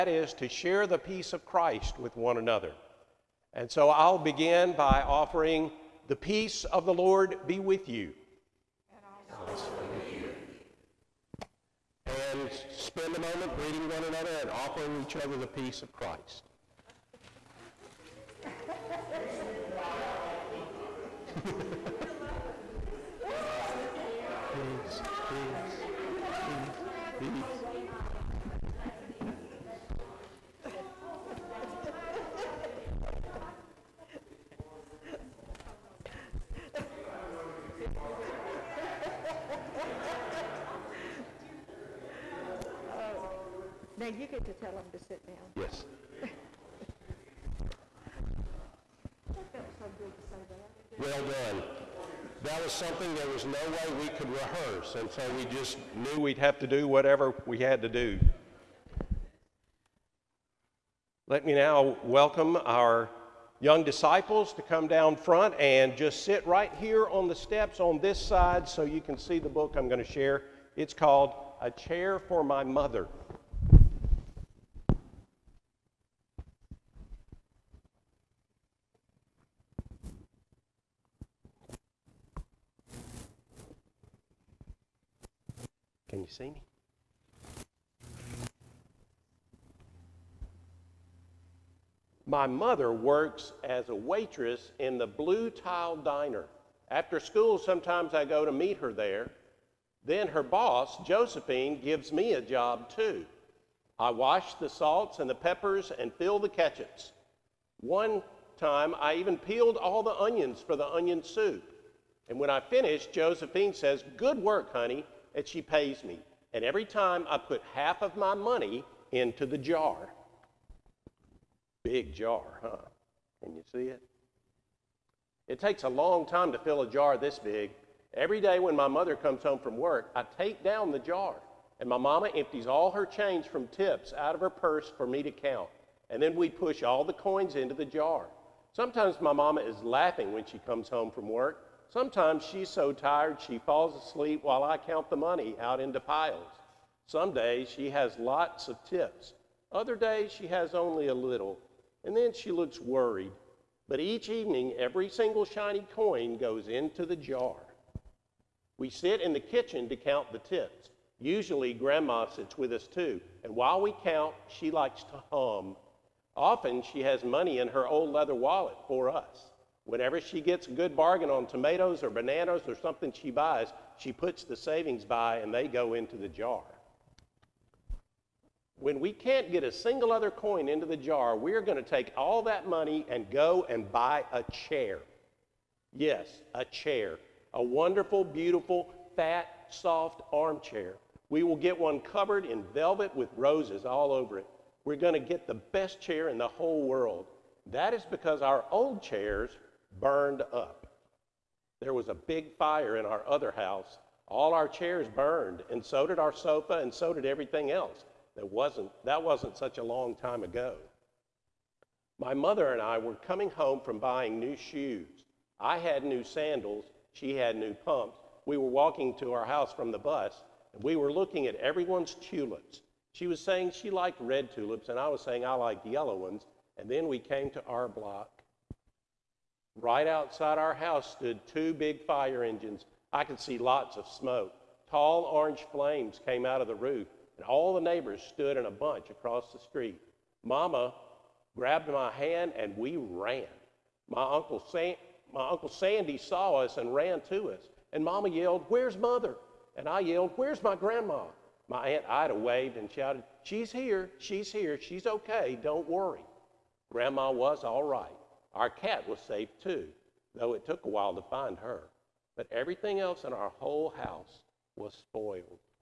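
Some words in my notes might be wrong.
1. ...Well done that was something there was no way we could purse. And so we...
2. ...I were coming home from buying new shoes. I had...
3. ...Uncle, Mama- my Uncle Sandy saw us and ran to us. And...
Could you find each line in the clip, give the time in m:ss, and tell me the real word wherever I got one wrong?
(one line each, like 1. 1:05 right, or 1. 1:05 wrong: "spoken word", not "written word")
1. 0:50 wrong: "rehearse", not "purse"
2. 3:32 right
3. 4:04 wrong: "San", not "Mama".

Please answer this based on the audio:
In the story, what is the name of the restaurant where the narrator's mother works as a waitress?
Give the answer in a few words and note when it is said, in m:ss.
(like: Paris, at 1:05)
Blue Tile Diner, at 1:35.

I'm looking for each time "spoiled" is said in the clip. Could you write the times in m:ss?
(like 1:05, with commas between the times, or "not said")
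4:24.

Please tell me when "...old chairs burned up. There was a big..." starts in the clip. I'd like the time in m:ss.
3:18.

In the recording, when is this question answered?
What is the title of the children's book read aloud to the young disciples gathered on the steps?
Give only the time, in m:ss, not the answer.
1:11.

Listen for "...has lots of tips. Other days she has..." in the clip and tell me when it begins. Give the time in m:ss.
2:27.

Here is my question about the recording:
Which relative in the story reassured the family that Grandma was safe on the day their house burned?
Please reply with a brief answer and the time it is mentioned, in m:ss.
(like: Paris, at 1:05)
Aunt Ida, at 4:11.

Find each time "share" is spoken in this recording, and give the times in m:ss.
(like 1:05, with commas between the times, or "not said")
0:00, 1:10.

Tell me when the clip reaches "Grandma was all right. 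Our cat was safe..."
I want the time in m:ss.
4:16.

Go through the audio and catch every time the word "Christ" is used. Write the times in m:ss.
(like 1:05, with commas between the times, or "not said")
0:01, 0:15.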